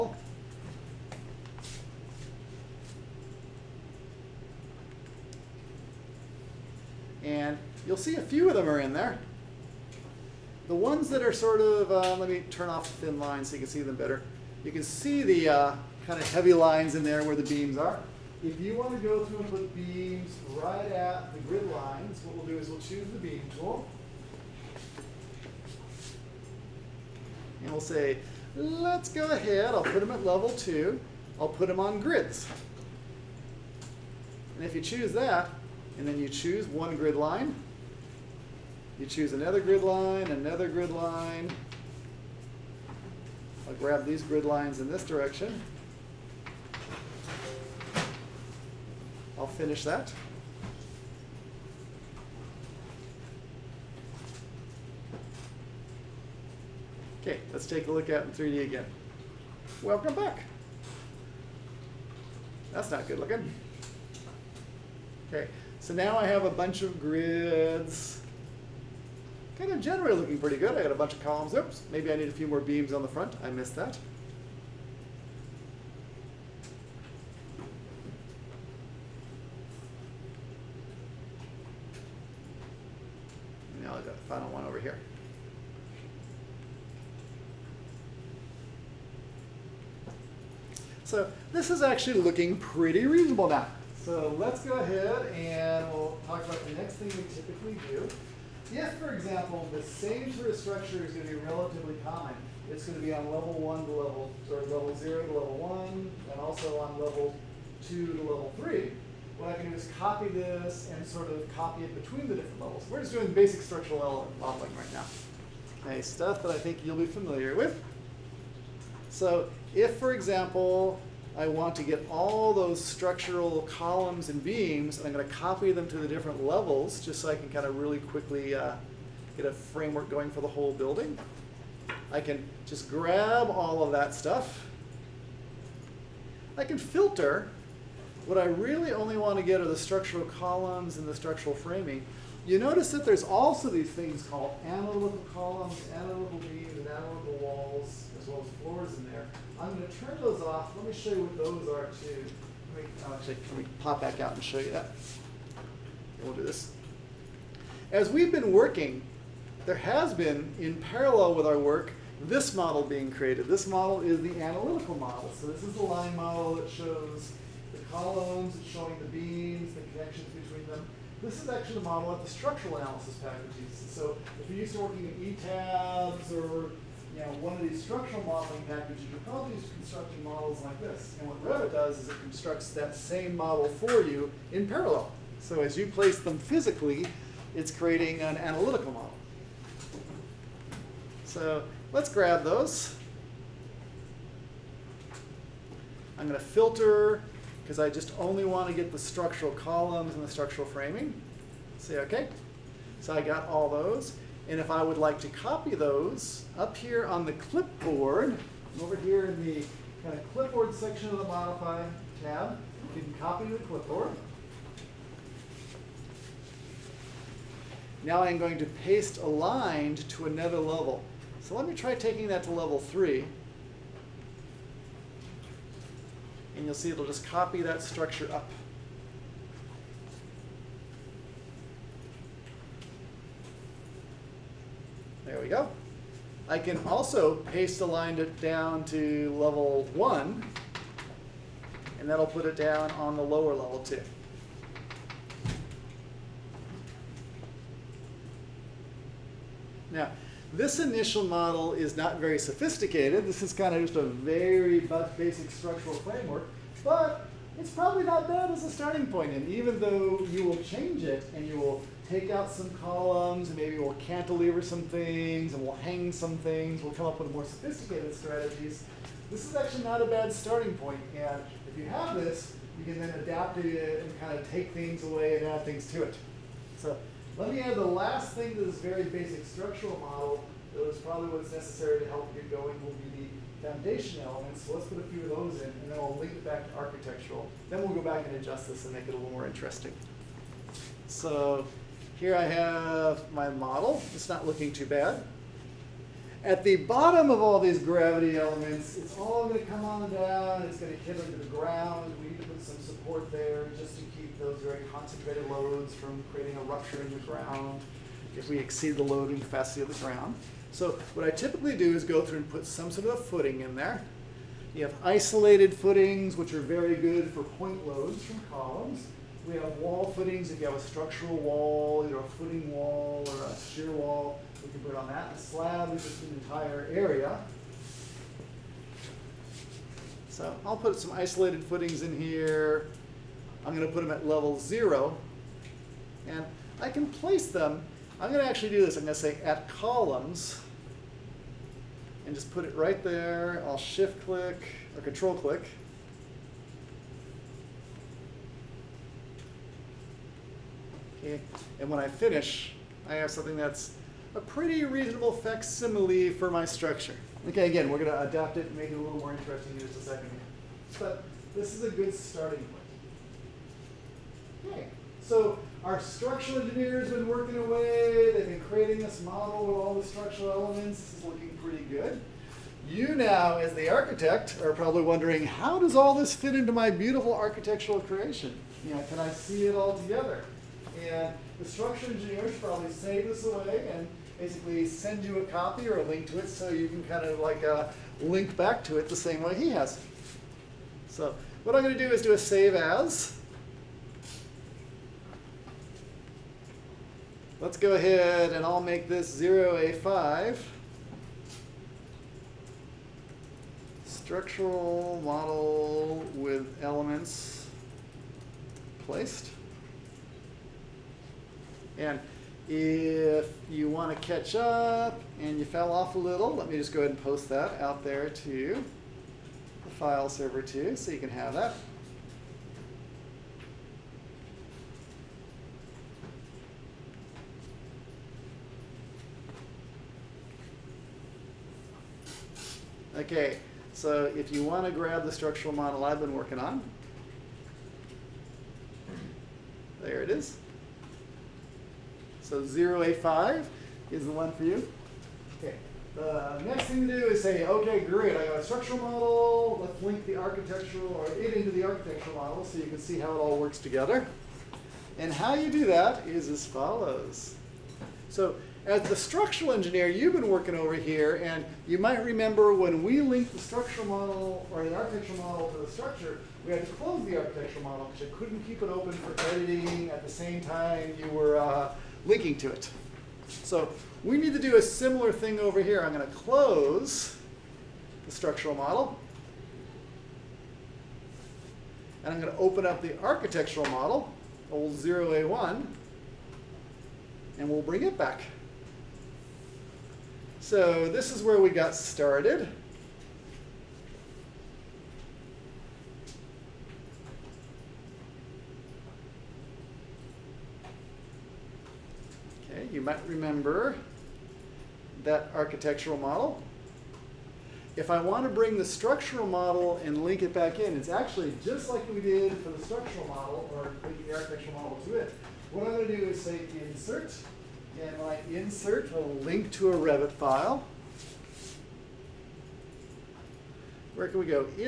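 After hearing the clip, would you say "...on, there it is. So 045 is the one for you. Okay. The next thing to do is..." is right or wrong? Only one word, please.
wrong.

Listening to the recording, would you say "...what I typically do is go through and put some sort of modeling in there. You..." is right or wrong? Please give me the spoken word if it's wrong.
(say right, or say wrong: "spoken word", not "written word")
wrong: "footing", not "modeling".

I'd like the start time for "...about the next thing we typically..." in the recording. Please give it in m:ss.
1:36.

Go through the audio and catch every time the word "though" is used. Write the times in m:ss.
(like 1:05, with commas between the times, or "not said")
4:19.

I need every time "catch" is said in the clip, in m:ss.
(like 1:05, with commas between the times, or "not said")
6:54.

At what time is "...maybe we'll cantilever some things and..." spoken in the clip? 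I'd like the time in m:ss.
4:23.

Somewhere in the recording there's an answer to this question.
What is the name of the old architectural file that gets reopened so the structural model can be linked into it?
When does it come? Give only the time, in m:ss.
8:04.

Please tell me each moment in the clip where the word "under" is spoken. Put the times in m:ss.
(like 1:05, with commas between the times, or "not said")
5:01.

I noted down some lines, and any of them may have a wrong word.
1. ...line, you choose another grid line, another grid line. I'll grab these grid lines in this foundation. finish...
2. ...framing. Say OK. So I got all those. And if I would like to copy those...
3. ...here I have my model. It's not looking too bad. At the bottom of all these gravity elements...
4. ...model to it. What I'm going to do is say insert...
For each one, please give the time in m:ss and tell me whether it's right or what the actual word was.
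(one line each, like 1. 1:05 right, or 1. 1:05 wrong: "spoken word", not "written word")
1. 0:37 wrong: "direction", not "foundation"
2. 3:20 right
3. 4:52 right
4. 8:34 right.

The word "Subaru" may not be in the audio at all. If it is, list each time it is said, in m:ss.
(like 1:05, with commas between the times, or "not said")
not said.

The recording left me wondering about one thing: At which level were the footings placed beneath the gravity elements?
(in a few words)
Level 0.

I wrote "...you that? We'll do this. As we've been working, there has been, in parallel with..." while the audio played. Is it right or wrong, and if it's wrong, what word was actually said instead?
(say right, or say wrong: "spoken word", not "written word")
right.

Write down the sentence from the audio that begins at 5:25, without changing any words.
The slab is just an entire area.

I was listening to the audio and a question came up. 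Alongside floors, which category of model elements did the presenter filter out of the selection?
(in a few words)
Analytical columns.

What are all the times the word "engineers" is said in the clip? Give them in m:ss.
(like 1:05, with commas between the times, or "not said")
6:06, 6:22, 7:39.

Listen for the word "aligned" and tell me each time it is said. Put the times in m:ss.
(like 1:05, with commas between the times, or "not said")
3:39, 3:57.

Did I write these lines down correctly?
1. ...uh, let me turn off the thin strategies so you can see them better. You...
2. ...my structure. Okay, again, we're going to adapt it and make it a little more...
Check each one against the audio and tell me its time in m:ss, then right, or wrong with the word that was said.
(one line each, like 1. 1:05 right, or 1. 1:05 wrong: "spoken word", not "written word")
1. 0:11 wrong: "lines", not "strategies"
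2. 5:56 right.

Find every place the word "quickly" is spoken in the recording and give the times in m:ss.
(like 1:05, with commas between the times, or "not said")
2:07.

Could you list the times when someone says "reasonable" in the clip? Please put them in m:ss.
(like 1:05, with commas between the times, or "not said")
1:33, 5:54.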